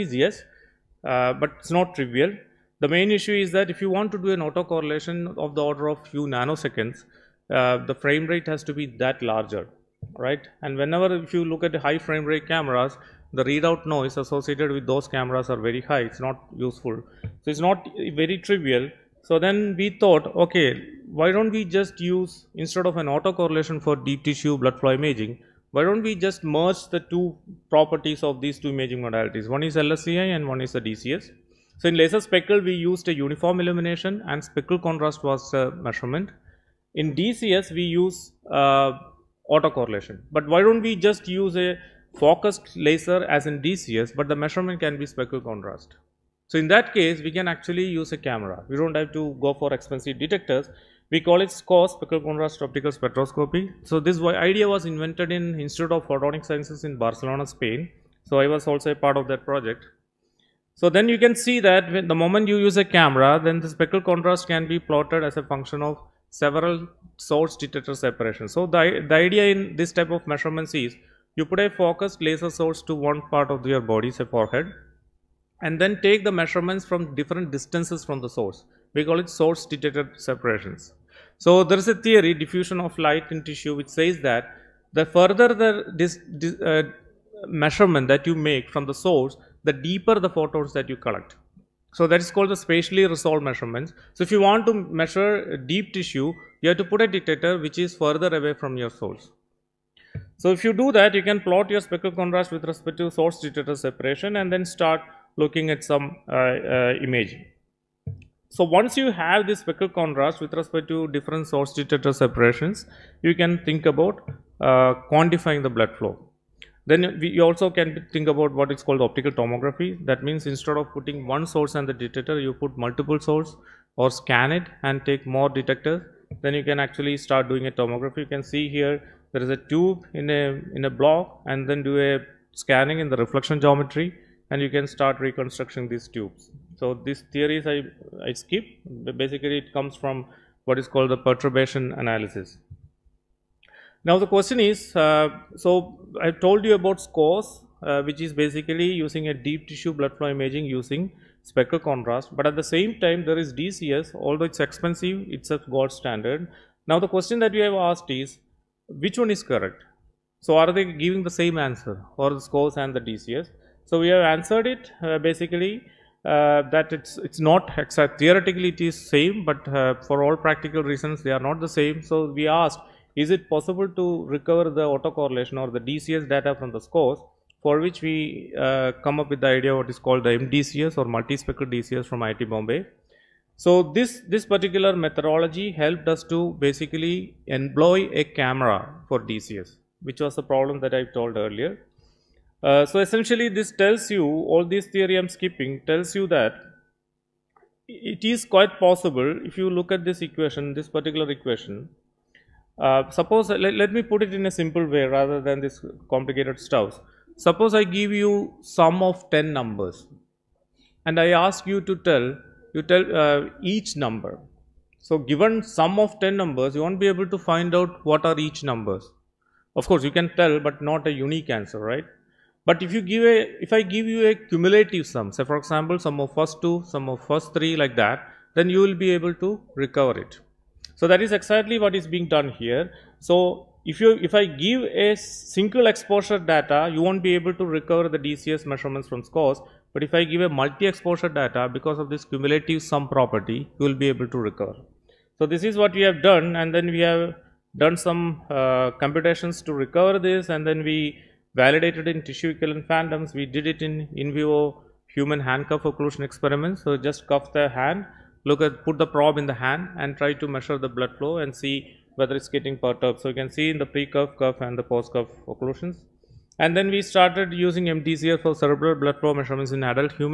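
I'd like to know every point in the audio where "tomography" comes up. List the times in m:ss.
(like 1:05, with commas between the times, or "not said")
1:59, 2:07.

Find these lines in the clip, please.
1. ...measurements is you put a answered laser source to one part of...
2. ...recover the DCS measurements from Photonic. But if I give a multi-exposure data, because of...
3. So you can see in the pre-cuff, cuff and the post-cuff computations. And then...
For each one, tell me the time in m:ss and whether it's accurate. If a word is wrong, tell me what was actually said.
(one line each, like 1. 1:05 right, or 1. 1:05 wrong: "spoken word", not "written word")
1. 1:10 wrong: "focused", not "answered"
2. 3:57 wrong: "SCOS", not "Photonic"
3. 4:23 wrong: "occlusions", not "computations".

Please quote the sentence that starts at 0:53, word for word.
So this idea was invented in Institute of Photonic Sciences in Barcelona, Spain.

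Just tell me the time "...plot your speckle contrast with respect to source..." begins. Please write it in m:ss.
1:41.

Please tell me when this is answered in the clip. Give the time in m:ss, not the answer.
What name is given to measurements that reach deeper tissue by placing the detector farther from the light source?
1:32.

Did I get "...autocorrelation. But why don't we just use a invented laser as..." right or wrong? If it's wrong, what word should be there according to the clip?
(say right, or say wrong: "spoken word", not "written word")
wrong: "focused", not "invented".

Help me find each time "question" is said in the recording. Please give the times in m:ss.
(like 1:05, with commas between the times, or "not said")
2:24, 2:37.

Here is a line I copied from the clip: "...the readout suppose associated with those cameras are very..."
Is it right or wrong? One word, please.
wrong.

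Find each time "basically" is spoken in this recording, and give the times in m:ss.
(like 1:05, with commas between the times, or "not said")
2:19, 2:28, 2:45, 3:06.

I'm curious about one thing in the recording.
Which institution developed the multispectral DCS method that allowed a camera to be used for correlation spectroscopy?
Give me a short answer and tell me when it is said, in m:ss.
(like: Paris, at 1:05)
IIT Bombay, at 3:02.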